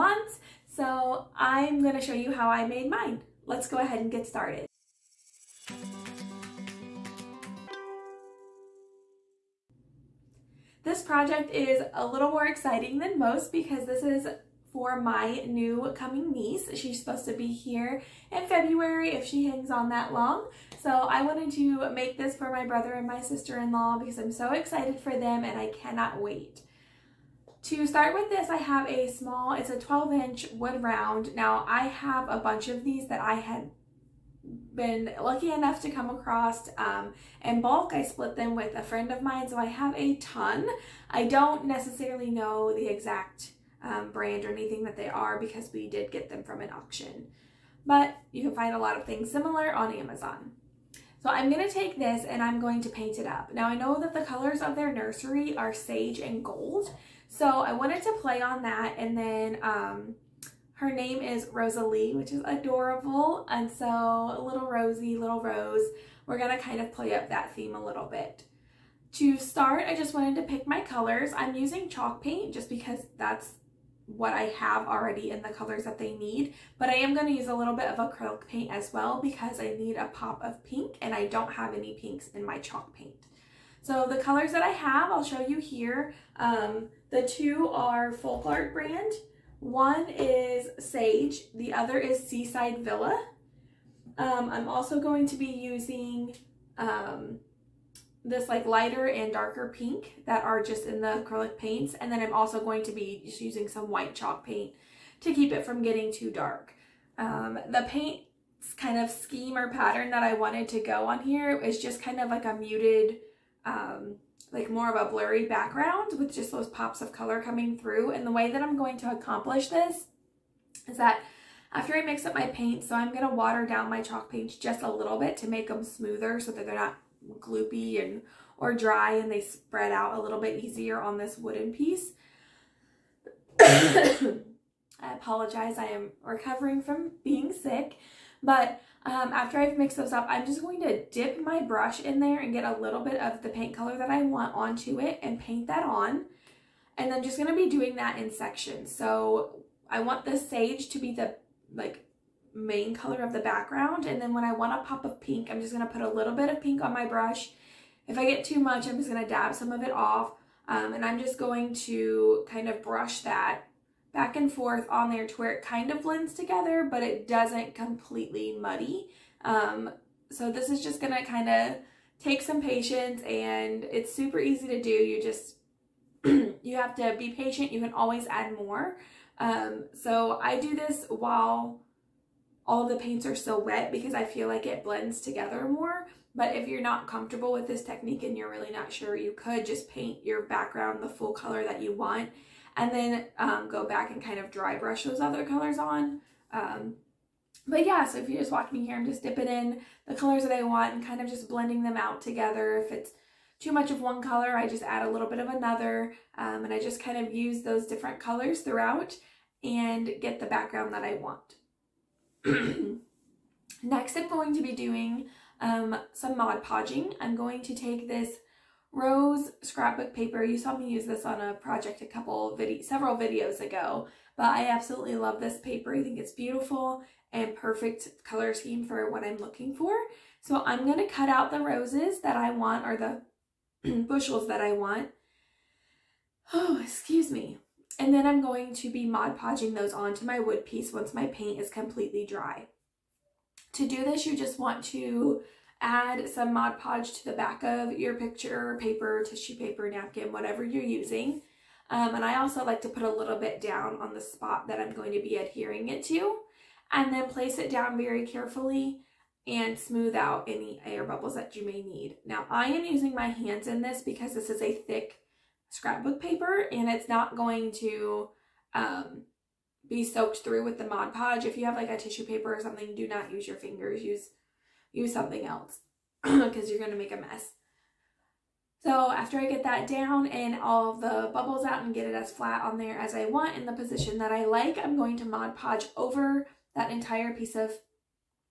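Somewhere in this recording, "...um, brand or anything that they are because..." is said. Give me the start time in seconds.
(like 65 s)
43 s.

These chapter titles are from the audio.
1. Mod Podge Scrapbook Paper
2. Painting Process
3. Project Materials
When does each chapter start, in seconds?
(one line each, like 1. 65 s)
1. 209 s
2. 140 s
3. 10 s.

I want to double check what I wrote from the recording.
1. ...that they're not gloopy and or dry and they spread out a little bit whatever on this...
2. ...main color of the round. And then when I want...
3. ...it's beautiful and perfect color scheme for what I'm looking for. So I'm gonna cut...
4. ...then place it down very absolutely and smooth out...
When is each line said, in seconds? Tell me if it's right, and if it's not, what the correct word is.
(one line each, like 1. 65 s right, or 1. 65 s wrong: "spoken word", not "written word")
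1. 126 s wrong: "easier", not "whatever"
2. 152 s wrong: "background", not "round"
3. 226 s right
4. 257 s wrong: "carefully", not "absolutely".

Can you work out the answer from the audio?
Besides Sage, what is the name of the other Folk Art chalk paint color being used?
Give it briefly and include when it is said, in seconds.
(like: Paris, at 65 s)
Seaside Villa, at 92 s.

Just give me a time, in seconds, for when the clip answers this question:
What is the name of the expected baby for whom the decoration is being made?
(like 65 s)
61 s.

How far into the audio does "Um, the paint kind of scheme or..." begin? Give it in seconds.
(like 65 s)
107 s.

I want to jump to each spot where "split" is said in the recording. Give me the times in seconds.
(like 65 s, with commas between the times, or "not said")
38 s.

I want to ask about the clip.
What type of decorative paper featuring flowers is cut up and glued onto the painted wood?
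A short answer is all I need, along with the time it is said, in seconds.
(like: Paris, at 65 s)
Rose scrapbook paper, at 218 s.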